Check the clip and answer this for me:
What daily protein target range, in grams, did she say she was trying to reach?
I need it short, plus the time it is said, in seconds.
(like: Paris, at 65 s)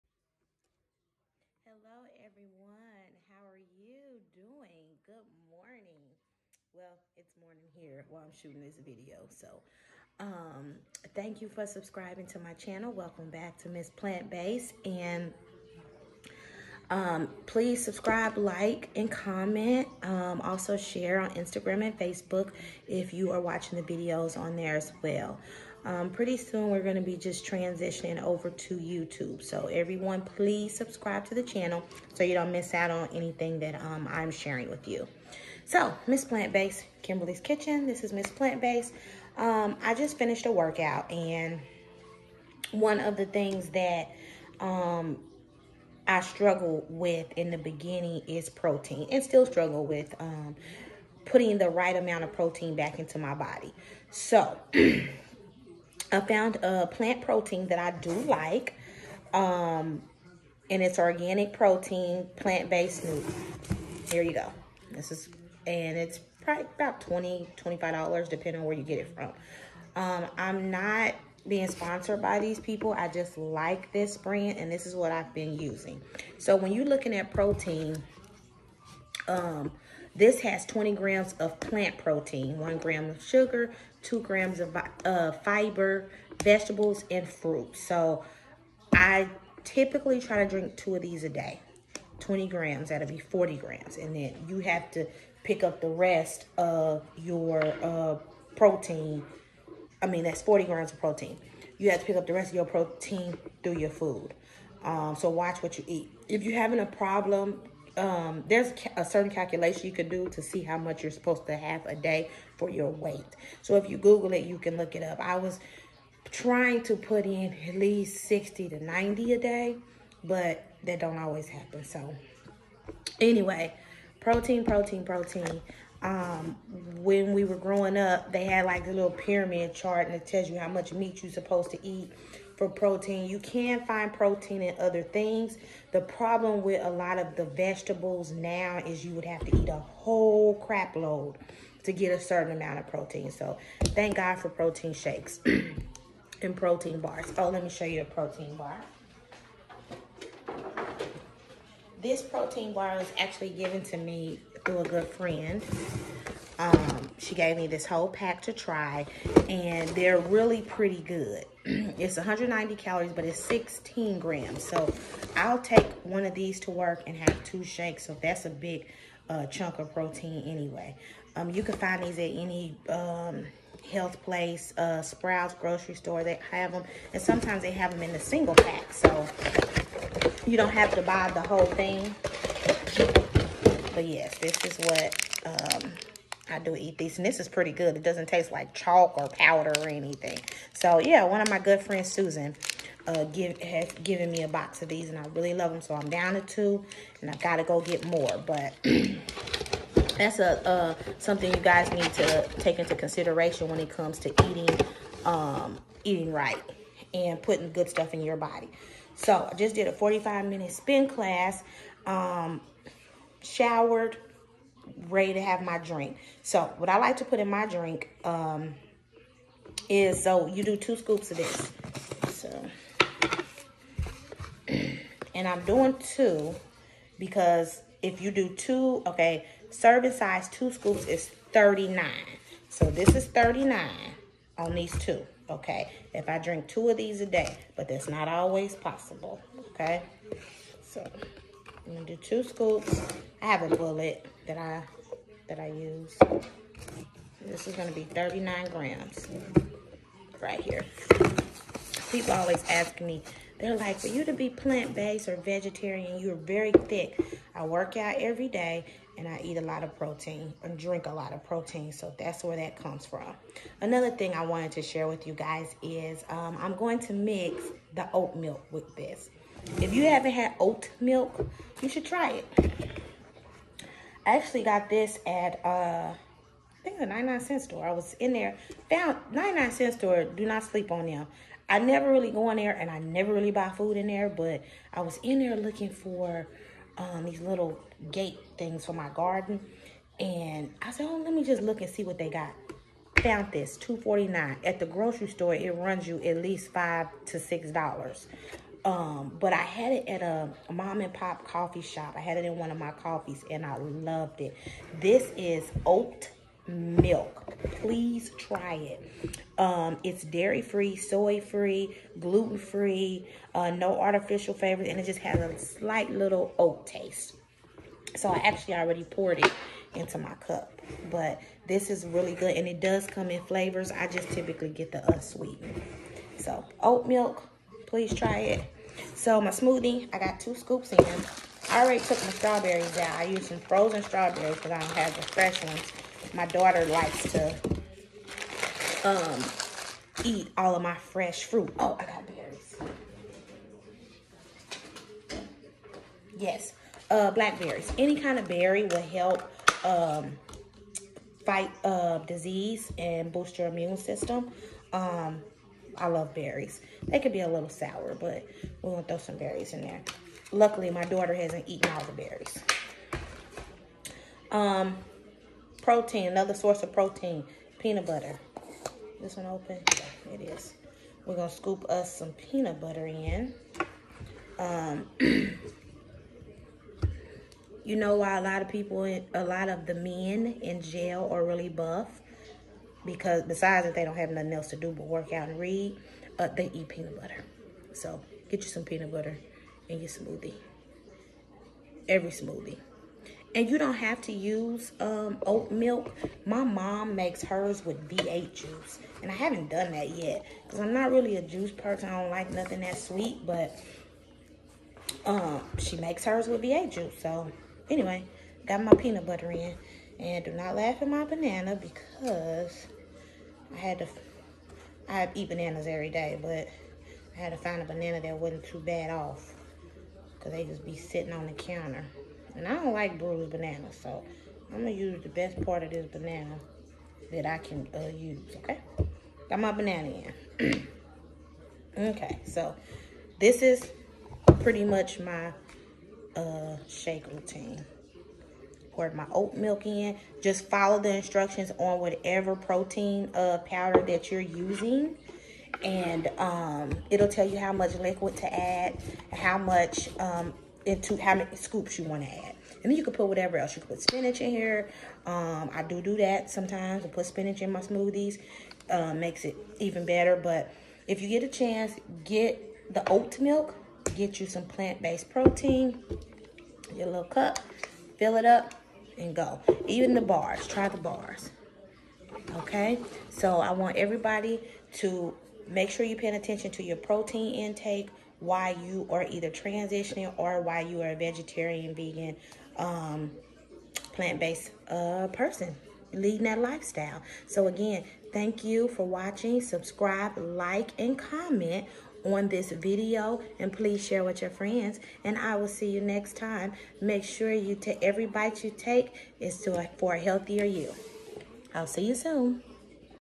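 60 to 90, at 118 s.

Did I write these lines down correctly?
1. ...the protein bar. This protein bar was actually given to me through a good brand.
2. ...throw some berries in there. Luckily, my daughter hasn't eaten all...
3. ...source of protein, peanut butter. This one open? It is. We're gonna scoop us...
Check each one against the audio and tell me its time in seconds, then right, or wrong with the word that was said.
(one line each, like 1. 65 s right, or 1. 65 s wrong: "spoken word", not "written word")
1. 148 s wrong: "friend", not "brand"
2. 359 s right
3. 366 s right.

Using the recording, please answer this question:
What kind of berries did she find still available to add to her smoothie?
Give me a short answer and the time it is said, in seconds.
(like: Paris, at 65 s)
Blackberries, at 347 s.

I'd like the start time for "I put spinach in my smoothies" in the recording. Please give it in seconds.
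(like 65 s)
457 s.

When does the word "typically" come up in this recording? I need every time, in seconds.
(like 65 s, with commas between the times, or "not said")
89 s, 324 s.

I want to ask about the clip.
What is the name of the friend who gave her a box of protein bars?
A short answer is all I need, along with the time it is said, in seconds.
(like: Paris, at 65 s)
Susan, at 192 s.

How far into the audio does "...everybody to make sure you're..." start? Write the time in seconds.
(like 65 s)
473 s.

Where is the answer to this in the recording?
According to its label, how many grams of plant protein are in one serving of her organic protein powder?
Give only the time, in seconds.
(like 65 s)
80 s.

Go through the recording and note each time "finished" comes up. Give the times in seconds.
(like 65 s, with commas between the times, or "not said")
40 s.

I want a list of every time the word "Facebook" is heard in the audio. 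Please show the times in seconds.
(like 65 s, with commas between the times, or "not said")
21 s.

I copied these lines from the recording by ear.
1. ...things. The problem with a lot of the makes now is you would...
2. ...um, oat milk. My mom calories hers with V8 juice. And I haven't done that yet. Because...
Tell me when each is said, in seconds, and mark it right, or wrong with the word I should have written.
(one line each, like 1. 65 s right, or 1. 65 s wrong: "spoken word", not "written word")
1. 135 s wrong: "vegetables", not "makes"
2. 394 s wrong: "makes", not "calories".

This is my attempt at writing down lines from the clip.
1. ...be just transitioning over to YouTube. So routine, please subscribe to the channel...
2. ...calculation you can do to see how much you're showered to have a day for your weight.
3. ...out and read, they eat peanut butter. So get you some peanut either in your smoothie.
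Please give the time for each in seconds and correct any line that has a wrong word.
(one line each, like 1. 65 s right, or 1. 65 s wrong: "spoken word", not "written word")
1. 27 s wrong: "everyone", not "routine"
2. 109 s wrong: "supposed", not "showered"
3. 385 s wrong: "butter", not "either".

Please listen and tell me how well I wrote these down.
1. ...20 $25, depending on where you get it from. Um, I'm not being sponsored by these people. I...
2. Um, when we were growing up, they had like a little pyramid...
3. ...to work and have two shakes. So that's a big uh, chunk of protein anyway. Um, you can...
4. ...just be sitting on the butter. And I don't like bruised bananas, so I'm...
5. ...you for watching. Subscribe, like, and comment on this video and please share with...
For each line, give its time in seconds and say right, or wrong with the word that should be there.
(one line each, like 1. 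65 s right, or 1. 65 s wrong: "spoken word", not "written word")
1. 67 s right
2. 126 s right
3. 166 s right
4. 420 s wrong: "counter", not "butter"
5. 488 s right.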